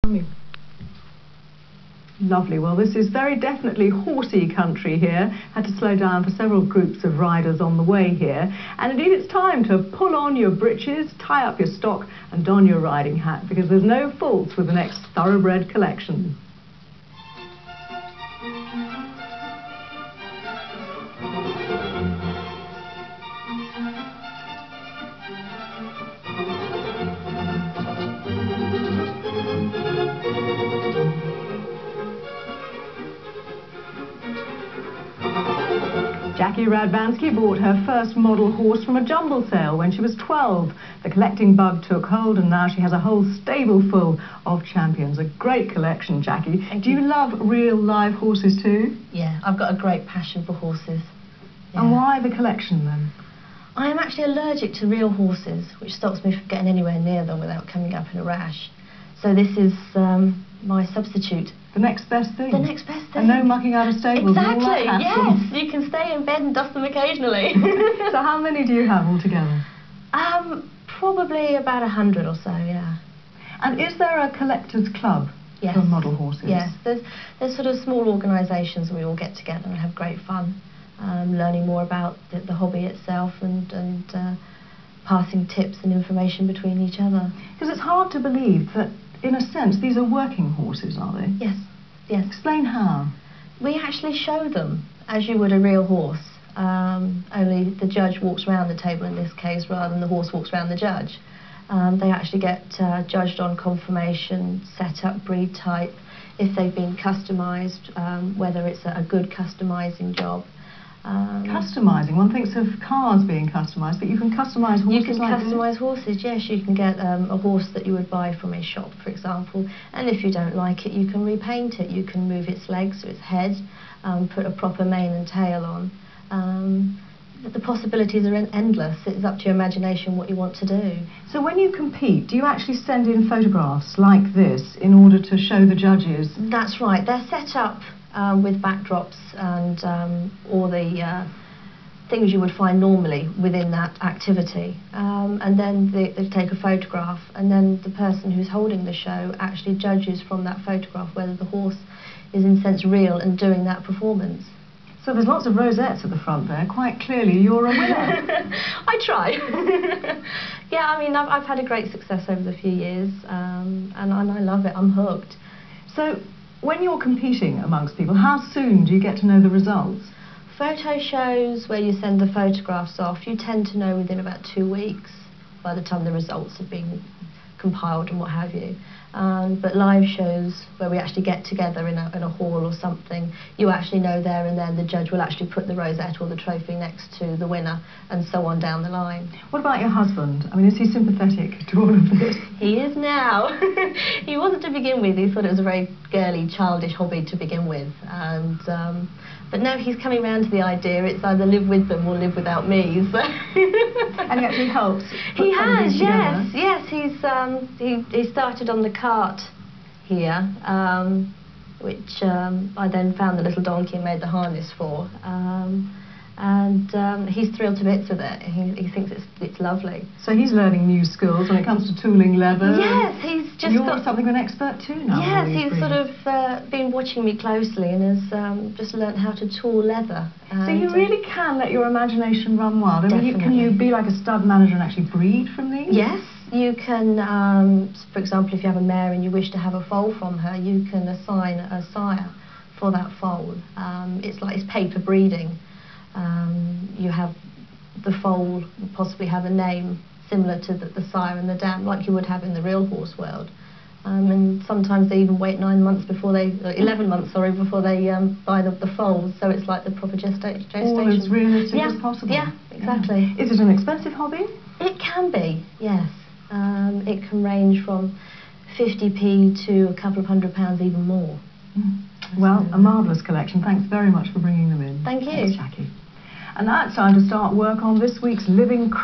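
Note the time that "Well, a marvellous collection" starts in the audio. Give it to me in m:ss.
4:32.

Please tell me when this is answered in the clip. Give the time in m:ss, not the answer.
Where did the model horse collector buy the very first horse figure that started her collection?
0:39.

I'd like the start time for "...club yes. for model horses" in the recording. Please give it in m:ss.
1:14.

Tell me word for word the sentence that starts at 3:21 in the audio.
It's either live with them or live without me.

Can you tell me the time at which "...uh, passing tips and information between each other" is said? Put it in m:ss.
1:24.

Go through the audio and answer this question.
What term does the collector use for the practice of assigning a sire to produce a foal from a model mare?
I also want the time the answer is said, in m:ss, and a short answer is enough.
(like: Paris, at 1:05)
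paper breeding, at 4:04.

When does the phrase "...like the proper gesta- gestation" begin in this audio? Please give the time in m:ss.
4:19.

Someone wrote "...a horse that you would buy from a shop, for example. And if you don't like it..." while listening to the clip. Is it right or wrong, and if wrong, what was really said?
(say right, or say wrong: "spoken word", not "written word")
right.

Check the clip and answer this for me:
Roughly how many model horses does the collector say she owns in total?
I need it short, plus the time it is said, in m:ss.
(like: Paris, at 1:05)
about 100, at 1:11.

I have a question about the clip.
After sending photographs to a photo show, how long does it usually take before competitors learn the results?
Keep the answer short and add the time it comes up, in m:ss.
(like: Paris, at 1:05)
about 2 weeks, at 2:54.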